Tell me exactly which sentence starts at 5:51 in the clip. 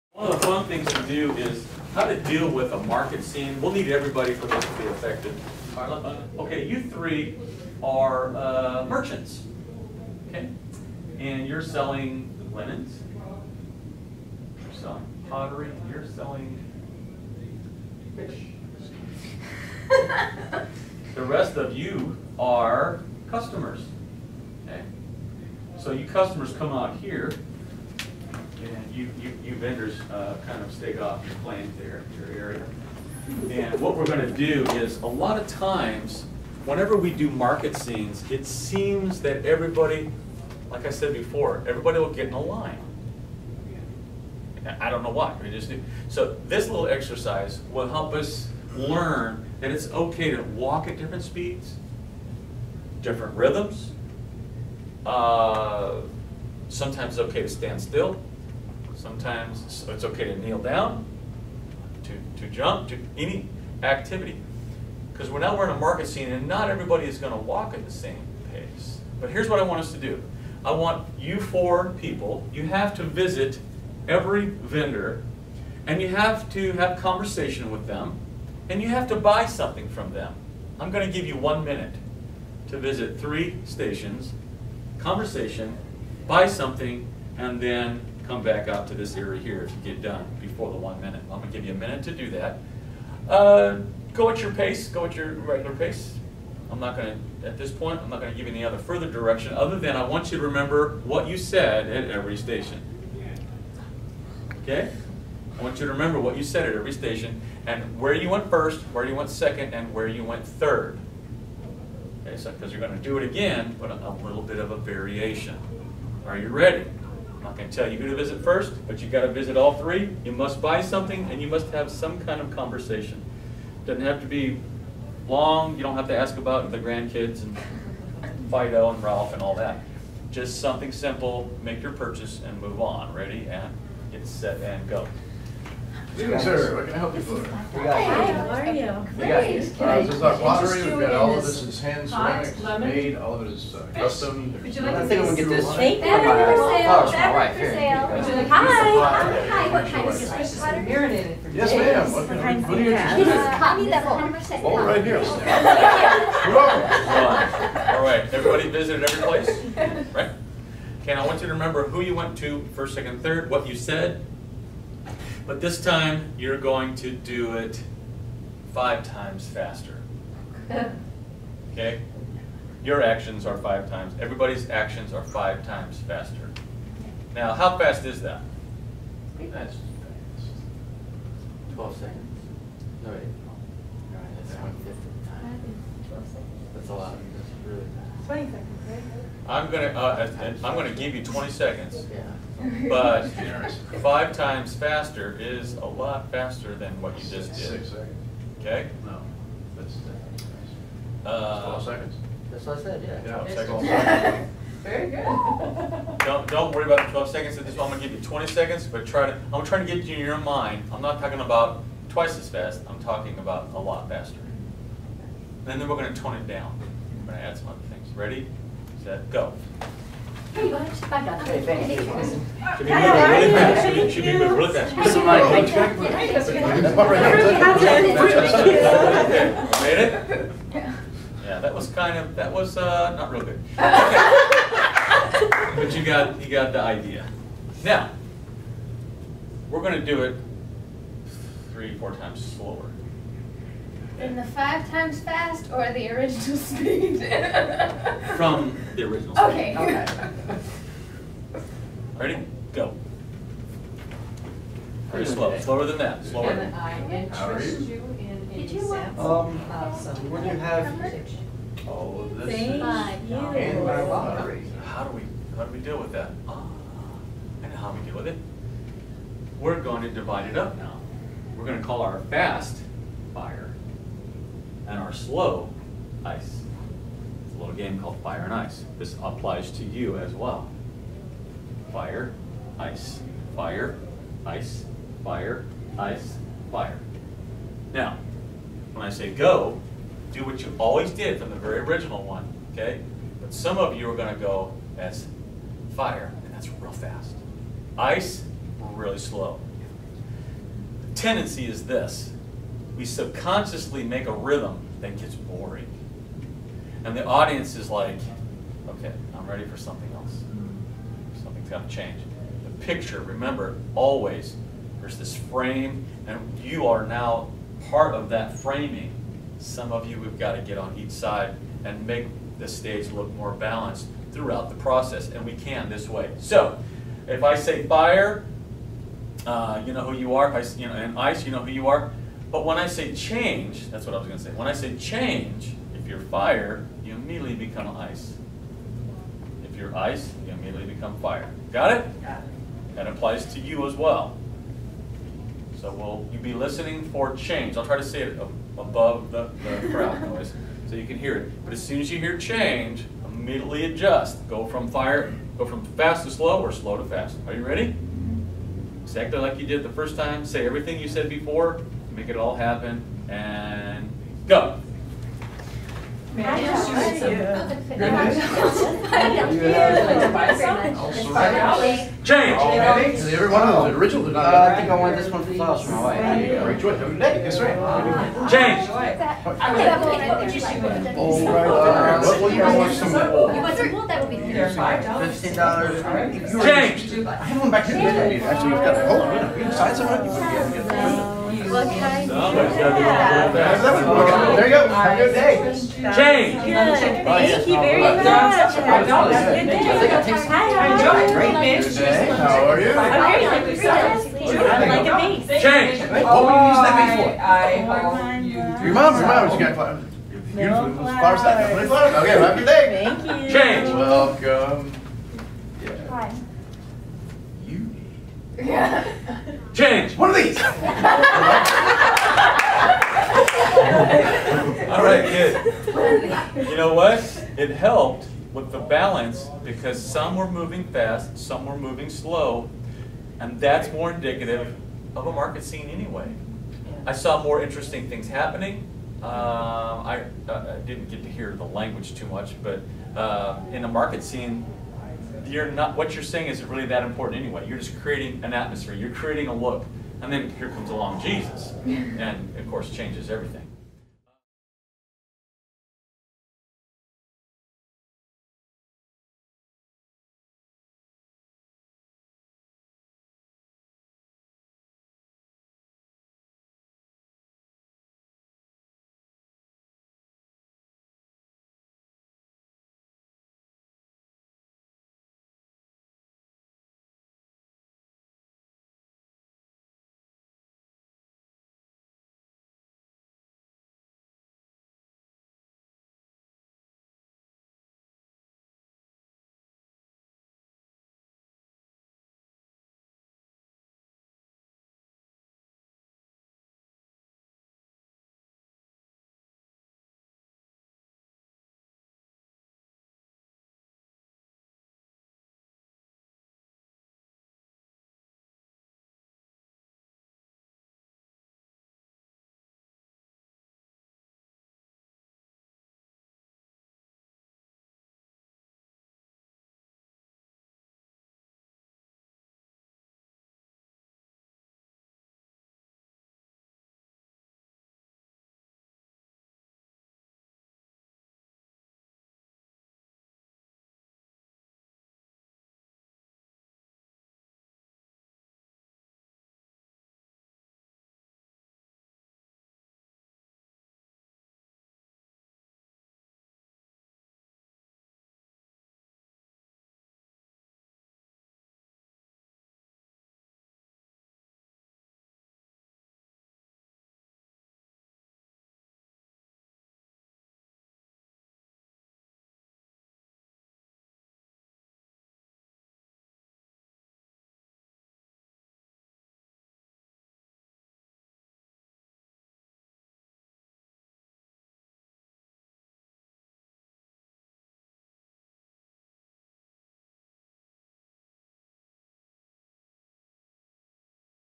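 But as soon as you hear change, immediately adjust.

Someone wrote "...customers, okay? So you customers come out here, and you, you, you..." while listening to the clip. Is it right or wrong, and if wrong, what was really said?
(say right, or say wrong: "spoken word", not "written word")
right.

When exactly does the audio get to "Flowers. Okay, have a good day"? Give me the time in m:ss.
6:51.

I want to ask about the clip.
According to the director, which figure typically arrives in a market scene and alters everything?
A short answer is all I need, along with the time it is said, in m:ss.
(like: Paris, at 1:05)
Jesus, at 7:31.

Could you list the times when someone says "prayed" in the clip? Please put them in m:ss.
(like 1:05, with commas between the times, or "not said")
not said.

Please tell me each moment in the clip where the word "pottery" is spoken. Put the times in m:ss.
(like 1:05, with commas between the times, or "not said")
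0:15, 2:20.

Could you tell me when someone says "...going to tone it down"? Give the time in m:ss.
3:35.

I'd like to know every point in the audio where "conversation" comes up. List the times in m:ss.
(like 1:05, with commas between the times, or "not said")
1:16, 1:24, 2:02.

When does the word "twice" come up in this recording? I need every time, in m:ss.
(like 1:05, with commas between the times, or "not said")
3:32.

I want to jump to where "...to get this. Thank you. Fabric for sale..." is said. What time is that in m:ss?
2:25.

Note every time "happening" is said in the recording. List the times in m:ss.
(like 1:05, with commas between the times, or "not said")
7:18.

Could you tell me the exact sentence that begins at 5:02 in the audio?
We subconsciously make a rhythm that gets boring.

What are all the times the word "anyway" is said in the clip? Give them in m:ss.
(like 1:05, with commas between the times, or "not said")
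7:15, 7:27.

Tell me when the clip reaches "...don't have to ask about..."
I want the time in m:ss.
2:05.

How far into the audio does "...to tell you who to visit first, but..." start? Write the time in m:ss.
1:57.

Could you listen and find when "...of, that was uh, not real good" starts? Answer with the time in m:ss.
3:52.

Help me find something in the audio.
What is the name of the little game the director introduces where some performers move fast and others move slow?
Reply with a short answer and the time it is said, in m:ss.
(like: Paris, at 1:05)
Fire and Ice, at 4:38.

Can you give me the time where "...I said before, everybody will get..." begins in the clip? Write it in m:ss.
0:40.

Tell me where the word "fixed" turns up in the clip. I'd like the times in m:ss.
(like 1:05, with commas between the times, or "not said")
not said.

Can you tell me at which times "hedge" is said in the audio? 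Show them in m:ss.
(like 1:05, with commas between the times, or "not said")
not said.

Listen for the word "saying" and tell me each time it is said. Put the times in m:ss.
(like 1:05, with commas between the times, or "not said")
7:26.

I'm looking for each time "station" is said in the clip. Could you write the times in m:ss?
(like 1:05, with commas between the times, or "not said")
1:23, 1:42, 1:46.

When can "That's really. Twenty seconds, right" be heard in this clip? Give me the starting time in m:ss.
3:07.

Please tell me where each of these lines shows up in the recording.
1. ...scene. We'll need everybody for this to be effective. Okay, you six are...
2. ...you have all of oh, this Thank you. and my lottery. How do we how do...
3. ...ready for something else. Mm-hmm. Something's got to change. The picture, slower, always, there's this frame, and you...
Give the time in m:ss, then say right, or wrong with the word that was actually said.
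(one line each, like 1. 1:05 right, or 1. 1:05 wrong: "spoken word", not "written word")
1. 0:03 wrong: "three", not "six"
2. 4:20 right
3. 5:09 wrong: "remember", not "slower".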